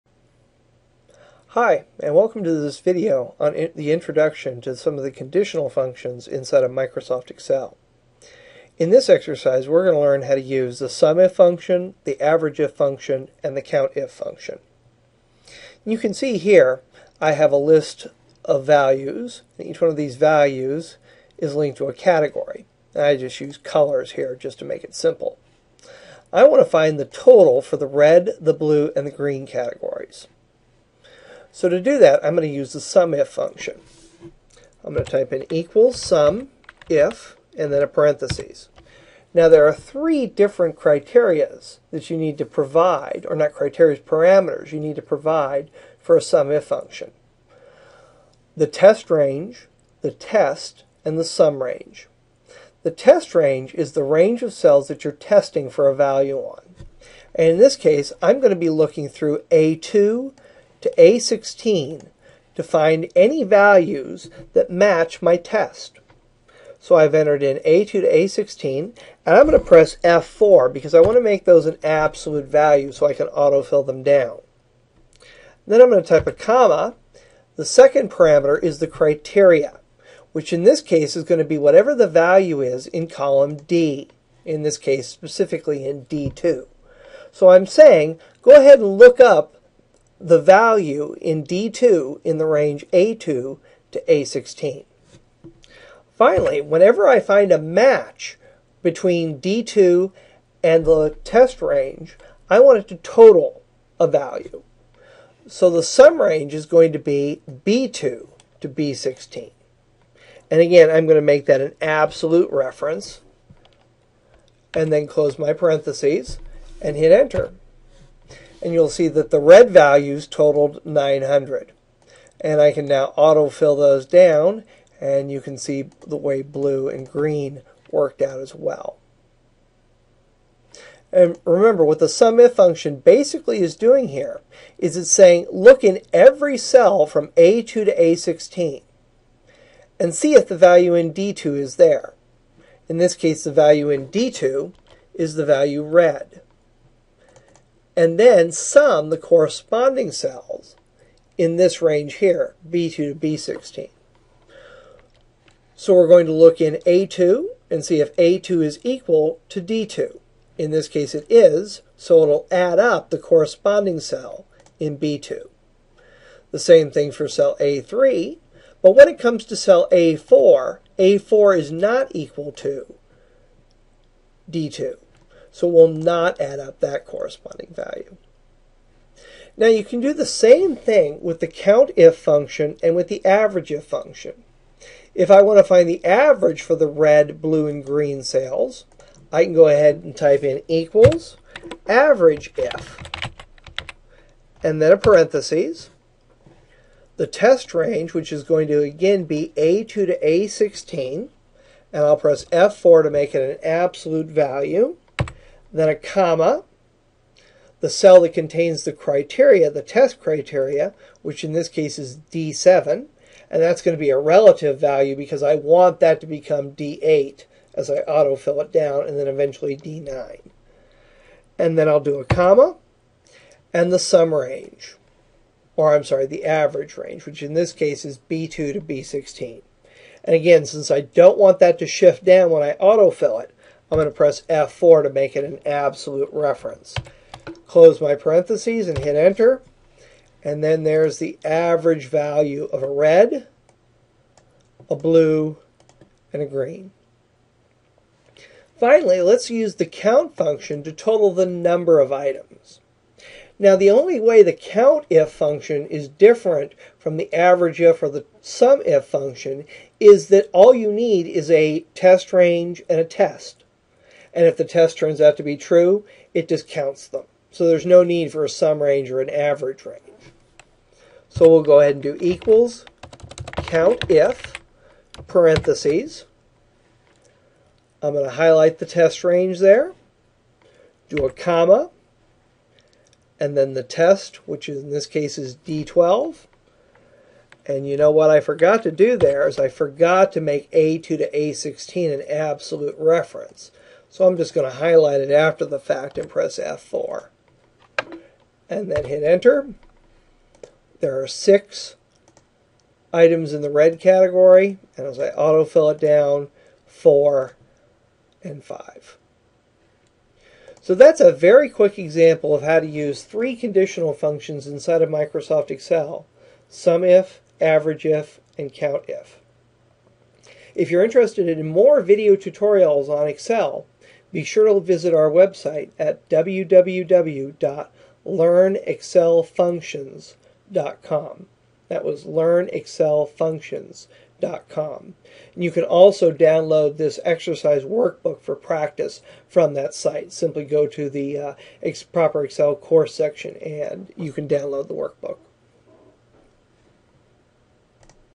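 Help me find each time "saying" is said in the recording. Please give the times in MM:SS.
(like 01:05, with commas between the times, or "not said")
01:27, 02:15.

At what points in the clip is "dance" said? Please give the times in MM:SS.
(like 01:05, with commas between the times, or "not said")
not said.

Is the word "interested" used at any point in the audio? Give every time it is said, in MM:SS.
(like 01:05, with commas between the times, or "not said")
05:21.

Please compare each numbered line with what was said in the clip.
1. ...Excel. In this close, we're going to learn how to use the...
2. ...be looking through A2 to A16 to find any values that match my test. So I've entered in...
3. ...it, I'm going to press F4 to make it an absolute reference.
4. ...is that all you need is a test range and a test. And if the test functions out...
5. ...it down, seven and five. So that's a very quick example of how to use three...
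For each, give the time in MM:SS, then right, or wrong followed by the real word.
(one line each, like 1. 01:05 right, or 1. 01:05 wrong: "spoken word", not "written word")
1. 00:07 wrong: "exercise", not "close"
2. 00:58 right
3. 03:53 right
4. 04:19 wrong: "turns", not "functions"
5. 05:05 wrong: "four", not "seven".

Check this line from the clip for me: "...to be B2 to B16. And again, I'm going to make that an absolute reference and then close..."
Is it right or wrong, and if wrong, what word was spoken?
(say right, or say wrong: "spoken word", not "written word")
right.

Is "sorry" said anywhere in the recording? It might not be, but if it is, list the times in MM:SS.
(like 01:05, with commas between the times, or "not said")
03:46.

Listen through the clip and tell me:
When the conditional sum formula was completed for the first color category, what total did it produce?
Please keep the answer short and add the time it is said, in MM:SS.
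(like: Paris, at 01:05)
900, at 02:00.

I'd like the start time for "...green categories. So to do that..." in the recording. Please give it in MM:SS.
00:29.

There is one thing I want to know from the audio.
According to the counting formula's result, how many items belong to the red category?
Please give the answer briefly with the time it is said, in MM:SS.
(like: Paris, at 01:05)
6, at 05:01.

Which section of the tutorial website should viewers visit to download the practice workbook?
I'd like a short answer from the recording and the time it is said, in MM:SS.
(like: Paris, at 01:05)
proper Excel course, at 05:42.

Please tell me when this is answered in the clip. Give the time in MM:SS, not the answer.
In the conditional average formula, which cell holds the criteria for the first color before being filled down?
03:32.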